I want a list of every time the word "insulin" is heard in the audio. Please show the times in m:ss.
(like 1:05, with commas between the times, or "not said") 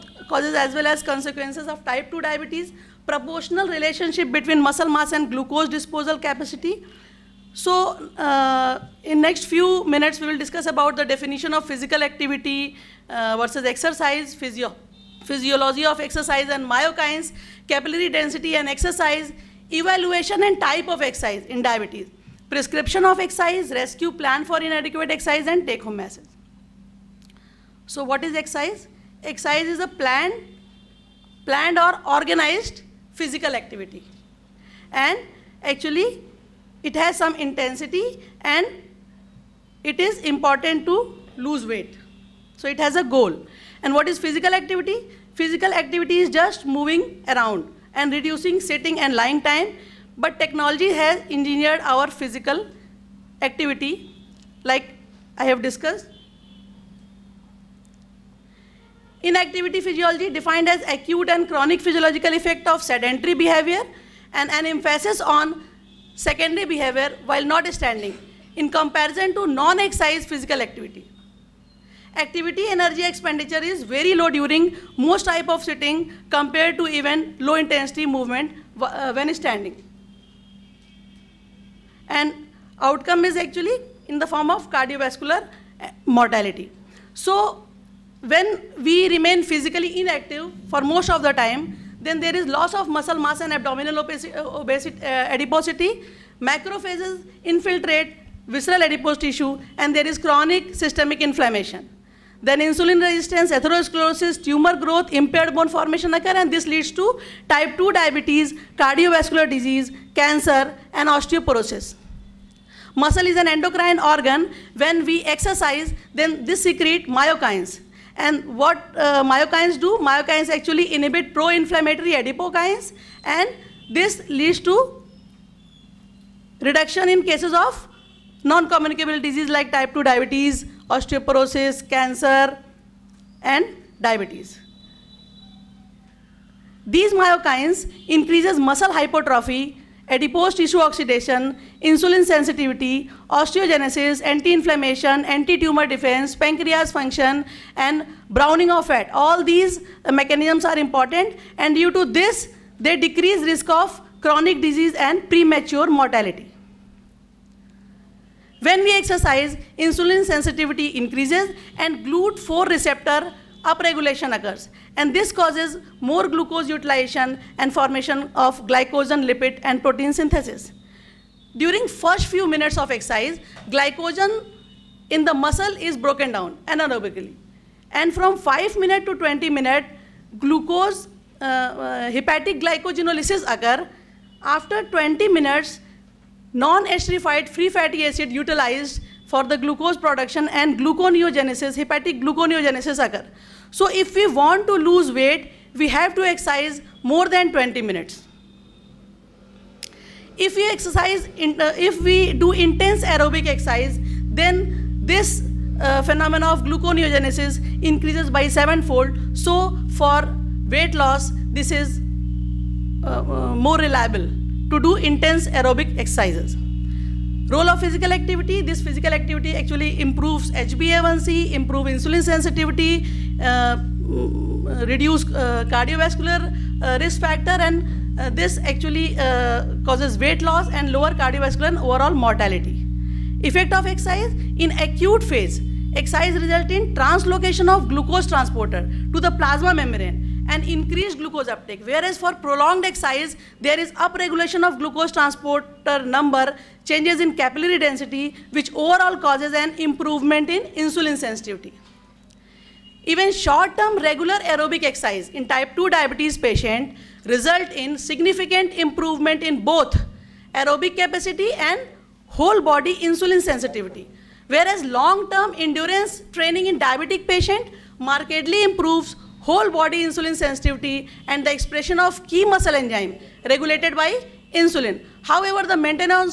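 1:42, 2:21, 2:39, 3:41, 4:10, 4:22, 4:30, 4:34.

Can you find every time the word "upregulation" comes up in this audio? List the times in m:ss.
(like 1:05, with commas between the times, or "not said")
2:43, 4:03.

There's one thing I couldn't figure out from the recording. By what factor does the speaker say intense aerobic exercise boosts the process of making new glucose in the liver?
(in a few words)
sevenfold.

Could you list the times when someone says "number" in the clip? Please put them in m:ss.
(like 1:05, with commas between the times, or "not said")
4:06.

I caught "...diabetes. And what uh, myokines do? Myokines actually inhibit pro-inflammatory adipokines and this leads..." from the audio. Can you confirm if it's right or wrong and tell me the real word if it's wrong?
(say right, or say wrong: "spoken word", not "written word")
wrong: "myokines", not "diabetes".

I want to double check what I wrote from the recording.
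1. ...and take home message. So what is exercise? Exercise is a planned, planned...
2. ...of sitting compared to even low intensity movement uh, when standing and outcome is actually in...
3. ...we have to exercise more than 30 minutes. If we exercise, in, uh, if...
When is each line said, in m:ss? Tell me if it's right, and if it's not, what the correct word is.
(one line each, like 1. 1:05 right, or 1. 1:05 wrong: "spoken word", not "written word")
1. 0:25 right
2. 1:15 right
3. 3:15 wrong: "20", not "30".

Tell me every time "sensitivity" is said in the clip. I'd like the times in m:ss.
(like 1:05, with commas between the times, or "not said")
2:22, 2:40, 3:42, 4:11, 4:23, 4:30.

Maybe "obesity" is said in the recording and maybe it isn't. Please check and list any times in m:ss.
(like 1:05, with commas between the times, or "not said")
1:33.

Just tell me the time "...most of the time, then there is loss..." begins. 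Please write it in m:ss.
1:30.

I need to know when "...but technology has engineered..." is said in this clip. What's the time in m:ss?
0:50.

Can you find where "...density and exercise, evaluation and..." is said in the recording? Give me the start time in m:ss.
0:18.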